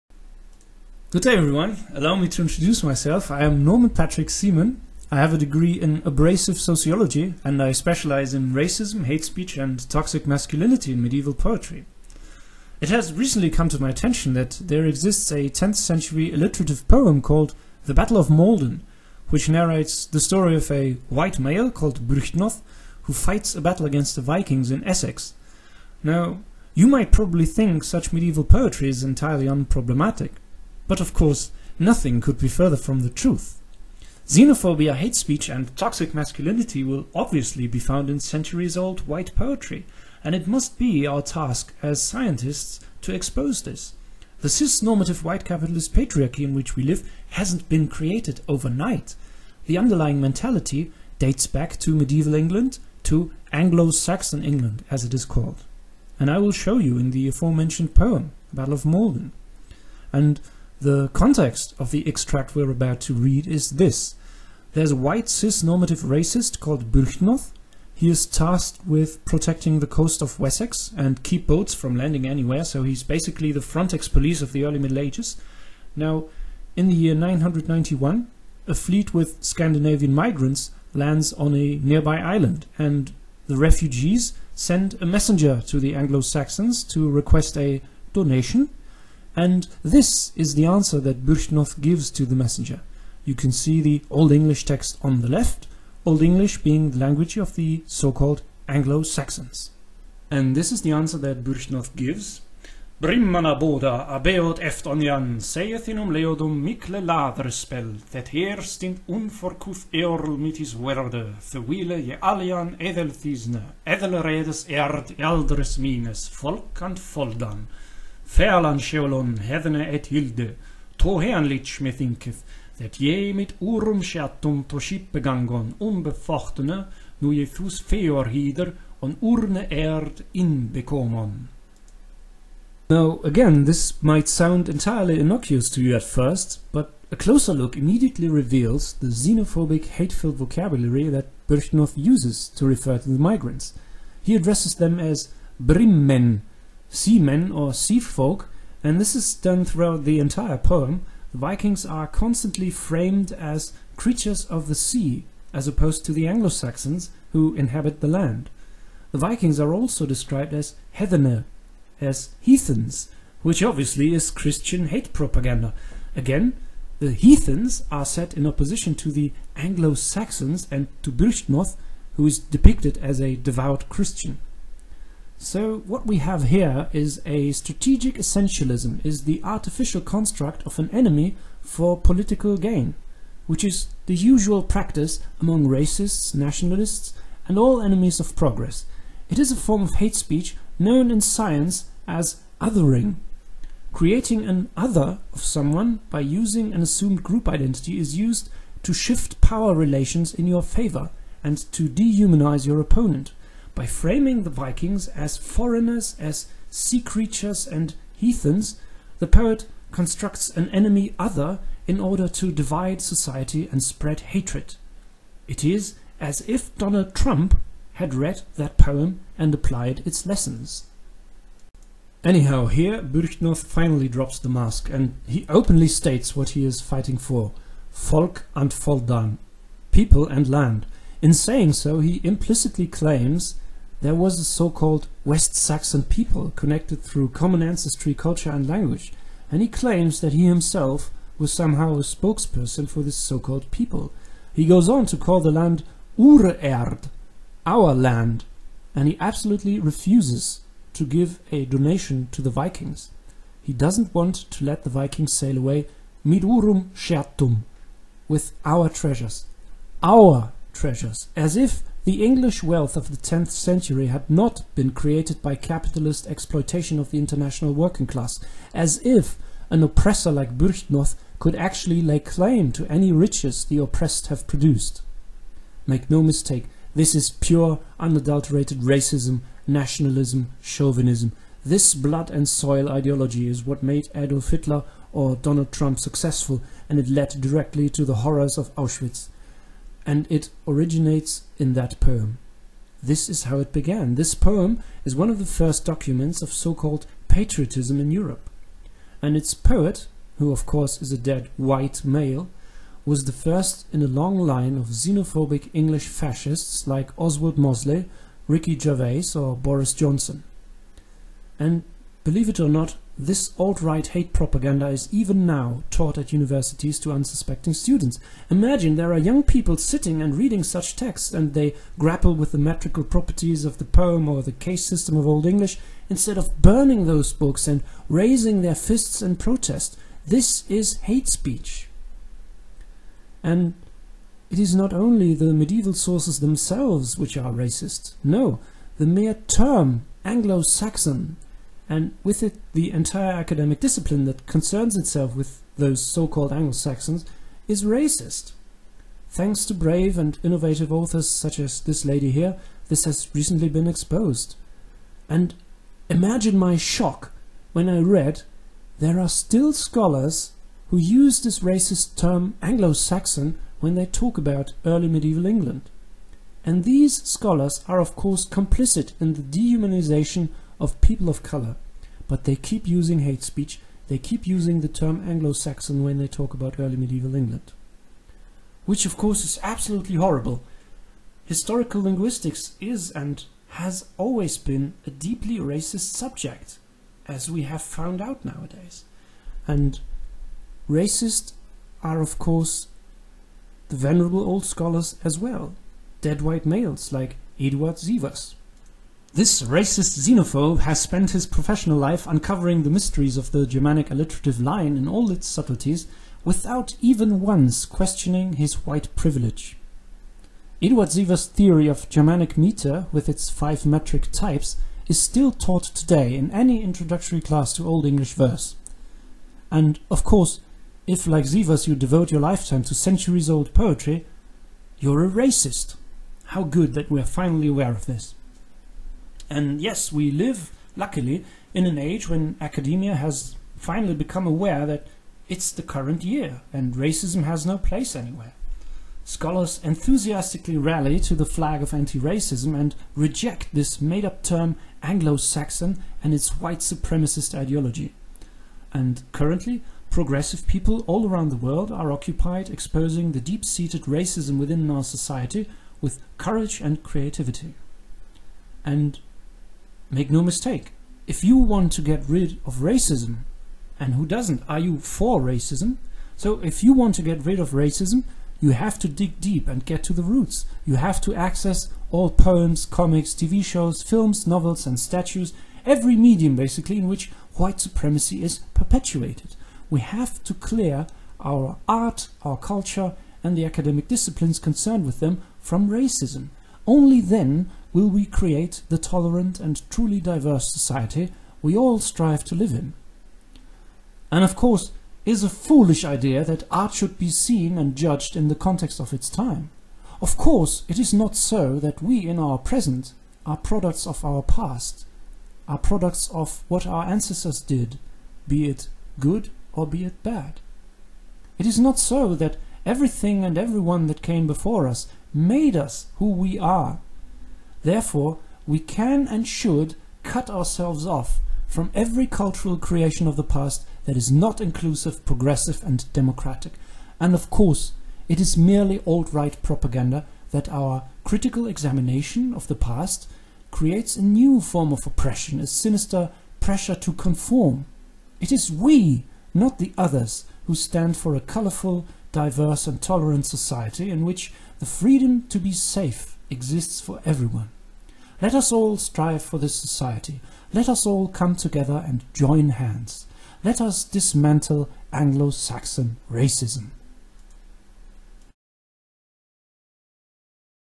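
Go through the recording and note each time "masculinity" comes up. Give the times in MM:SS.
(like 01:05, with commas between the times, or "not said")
00:10, 00:36.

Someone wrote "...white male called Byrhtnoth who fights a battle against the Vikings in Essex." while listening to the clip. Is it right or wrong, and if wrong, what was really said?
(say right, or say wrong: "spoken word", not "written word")
right.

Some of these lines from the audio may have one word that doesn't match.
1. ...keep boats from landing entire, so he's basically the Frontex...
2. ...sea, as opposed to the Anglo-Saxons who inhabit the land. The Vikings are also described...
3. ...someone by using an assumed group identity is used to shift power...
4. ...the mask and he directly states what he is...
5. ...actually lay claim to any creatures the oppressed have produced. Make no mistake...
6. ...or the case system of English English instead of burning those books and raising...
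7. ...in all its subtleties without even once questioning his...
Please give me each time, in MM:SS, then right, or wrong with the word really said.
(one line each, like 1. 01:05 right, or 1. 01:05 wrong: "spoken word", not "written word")
1. 01:11 wrong: "anywhere", not "entire"
2. 02:34 right
3. 03:15 right
4. 03:44 wrong: "openly", not "directly"
5. 04:31 wrong: "riches", not "creatures"
6. 05:24 wrong: "Old", not "English"
7. 06:44 right.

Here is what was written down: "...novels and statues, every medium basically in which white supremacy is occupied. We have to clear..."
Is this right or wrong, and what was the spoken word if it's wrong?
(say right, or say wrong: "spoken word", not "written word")
wrong: "perpetuated", not "occupied".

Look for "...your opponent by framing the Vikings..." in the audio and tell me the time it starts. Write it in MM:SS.
03:22.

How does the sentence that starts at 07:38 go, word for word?
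And Make no mistake, if you want to get rid of racism, and who doesn't?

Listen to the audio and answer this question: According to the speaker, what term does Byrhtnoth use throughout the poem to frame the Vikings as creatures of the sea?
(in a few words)
Brimmen.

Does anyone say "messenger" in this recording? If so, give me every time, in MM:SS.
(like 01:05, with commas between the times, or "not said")
01:25, 01:32.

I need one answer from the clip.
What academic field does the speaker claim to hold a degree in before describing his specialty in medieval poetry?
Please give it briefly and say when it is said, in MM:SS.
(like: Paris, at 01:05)
abrasive sociology, at 00:06.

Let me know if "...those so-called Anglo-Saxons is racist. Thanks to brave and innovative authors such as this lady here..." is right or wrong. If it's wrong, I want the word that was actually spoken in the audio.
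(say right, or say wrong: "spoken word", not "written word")
right.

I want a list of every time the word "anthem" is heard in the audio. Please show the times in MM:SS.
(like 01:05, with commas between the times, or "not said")
not said.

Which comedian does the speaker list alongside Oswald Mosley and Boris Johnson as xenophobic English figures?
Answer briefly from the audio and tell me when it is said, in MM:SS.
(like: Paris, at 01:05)
Ricky Gervais, at 05:08.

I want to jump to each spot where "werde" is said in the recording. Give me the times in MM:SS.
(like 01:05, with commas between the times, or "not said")
01:50.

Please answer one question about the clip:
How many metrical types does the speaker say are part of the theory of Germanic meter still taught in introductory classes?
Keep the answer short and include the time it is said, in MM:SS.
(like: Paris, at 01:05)
5, at 06:53.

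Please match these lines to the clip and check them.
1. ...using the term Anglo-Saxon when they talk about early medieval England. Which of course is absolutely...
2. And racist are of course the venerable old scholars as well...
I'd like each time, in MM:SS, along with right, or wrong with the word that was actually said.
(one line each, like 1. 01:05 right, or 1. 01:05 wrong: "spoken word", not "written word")
1. 06:14 right
2. 06:29 right.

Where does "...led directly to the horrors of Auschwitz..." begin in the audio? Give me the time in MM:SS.
04:47.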